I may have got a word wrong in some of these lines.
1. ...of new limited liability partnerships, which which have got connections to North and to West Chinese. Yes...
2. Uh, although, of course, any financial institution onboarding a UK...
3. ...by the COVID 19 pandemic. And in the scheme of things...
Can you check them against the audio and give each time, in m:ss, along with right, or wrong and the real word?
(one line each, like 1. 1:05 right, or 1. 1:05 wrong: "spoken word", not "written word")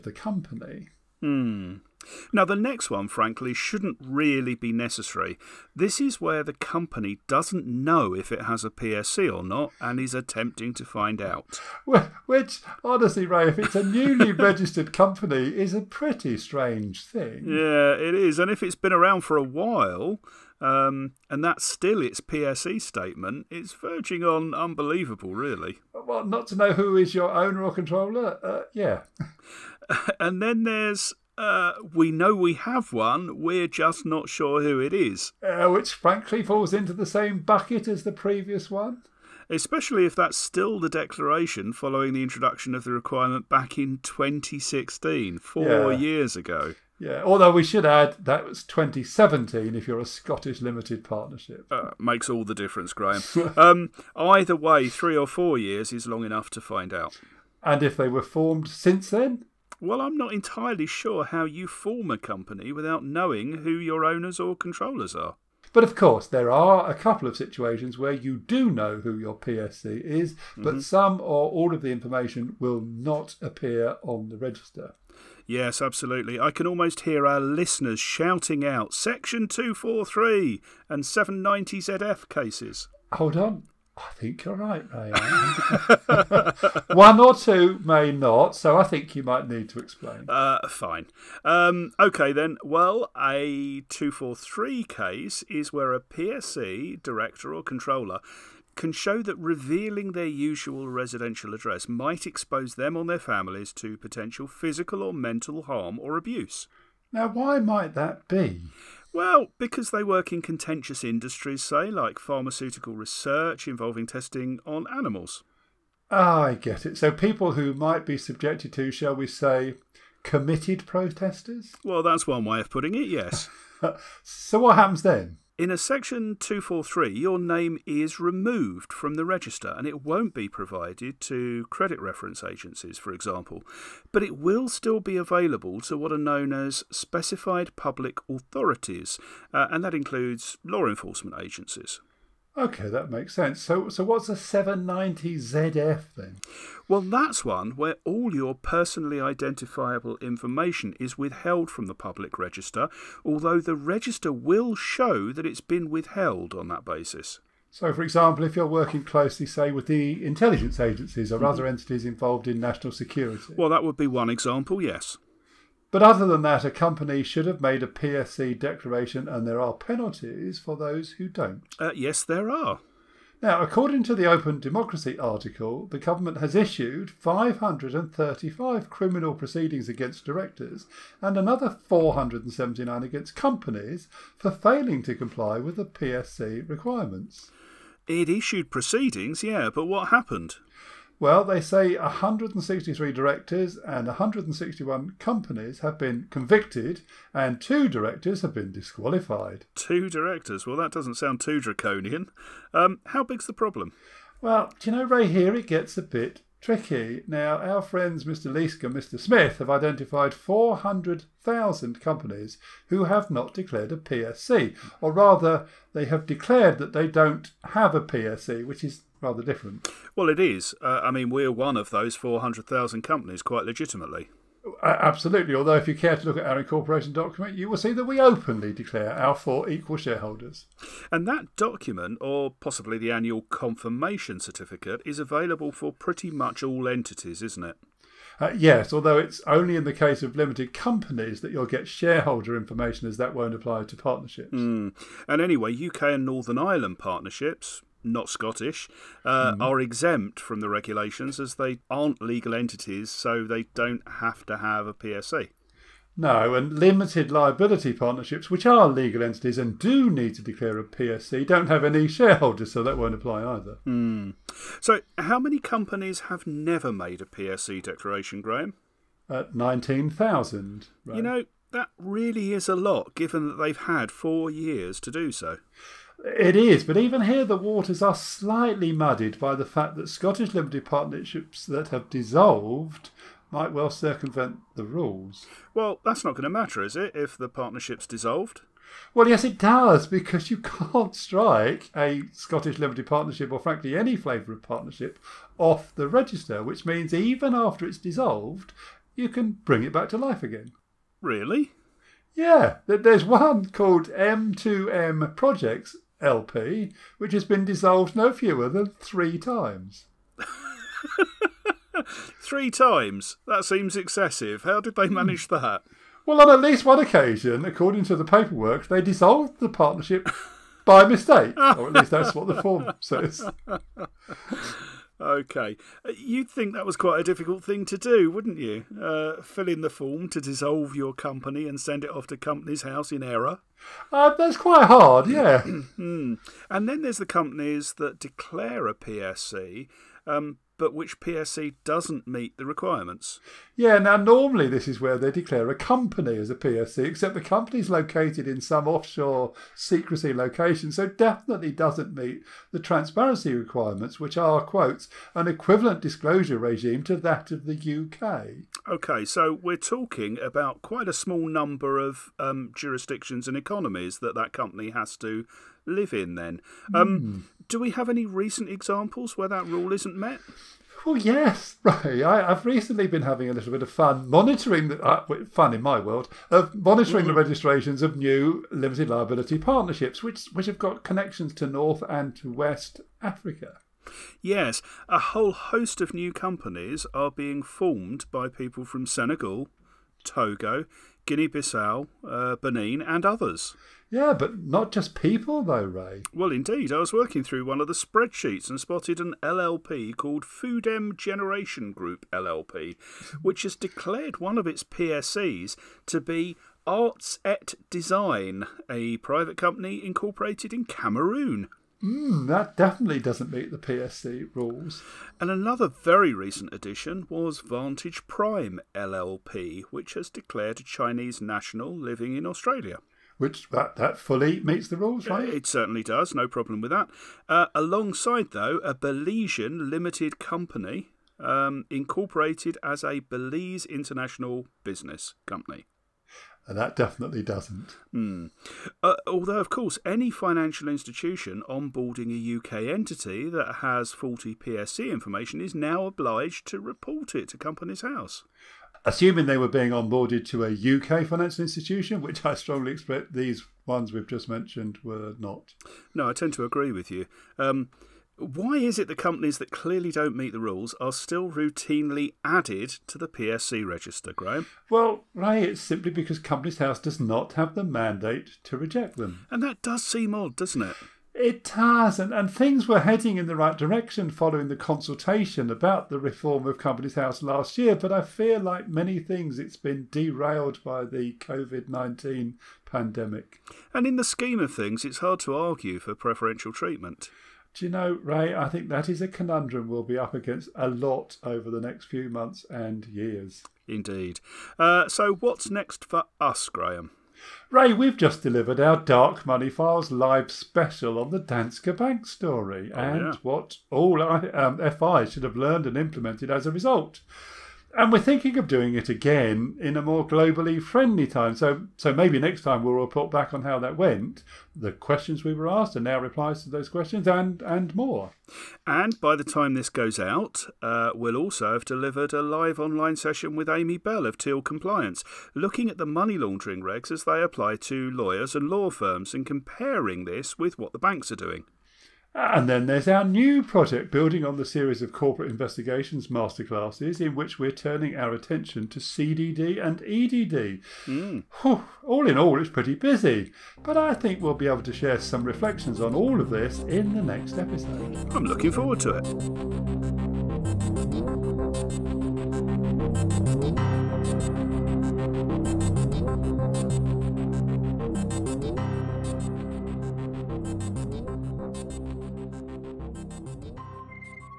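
1. 6:18 wrong: "Africa", not "Chinese"
2. 7:19 right
3. 8:00 right.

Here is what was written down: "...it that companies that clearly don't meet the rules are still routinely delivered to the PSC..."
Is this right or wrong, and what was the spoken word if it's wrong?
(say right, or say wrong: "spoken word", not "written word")
wrong: "added", not "delivered".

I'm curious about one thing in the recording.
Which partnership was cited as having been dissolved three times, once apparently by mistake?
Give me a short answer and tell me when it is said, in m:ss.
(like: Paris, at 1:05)
M2M Projects LP, at 5:04.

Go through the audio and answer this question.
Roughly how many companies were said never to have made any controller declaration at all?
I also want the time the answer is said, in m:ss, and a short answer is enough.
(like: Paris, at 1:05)
19,000, at 4:29.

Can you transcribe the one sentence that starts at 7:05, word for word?
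It certainly does, no problem with that.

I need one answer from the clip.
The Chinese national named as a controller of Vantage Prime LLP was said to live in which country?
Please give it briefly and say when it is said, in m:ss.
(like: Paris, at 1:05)
Australia, at 7:02.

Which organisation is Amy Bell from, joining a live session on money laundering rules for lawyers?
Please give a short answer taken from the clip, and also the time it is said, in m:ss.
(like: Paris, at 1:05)
Teal Compliance, at 8:44.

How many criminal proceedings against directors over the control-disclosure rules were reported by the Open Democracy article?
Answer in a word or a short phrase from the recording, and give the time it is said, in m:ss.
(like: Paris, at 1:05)
535, at 2:57.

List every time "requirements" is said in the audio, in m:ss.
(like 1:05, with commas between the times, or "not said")
0:42, 3:06, 5:42, 5:53.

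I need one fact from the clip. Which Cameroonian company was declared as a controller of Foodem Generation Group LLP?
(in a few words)
Arts et Design.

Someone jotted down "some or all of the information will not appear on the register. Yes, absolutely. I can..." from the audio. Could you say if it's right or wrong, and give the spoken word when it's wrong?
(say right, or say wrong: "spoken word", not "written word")
right.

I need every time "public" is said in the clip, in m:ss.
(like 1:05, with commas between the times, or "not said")
2:17, 2:31.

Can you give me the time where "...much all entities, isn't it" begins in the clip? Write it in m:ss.
3:56.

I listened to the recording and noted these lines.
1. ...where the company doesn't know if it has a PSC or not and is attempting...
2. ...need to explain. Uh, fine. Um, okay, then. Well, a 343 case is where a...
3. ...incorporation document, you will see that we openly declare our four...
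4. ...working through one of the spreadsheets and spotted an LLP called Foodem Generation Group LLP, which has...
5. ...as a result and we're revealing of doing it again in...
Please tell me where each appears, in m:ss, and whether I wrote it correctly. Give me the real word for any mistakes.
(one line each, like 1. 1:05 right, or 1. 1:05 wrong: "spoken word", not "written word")
1. 0:06 right
2. 1:29 wrong: "243", not "343"
3. 3:46 right
4. 6:37 right
5. 8:26 wrong: "thinking", not "revealing".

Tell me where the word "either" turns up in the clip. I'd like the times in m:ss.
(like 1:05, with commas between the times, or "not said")
0:54, 4:23.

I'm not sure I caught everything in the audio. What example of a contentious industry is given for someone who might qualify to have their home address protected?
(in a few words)
pharmaceutical research.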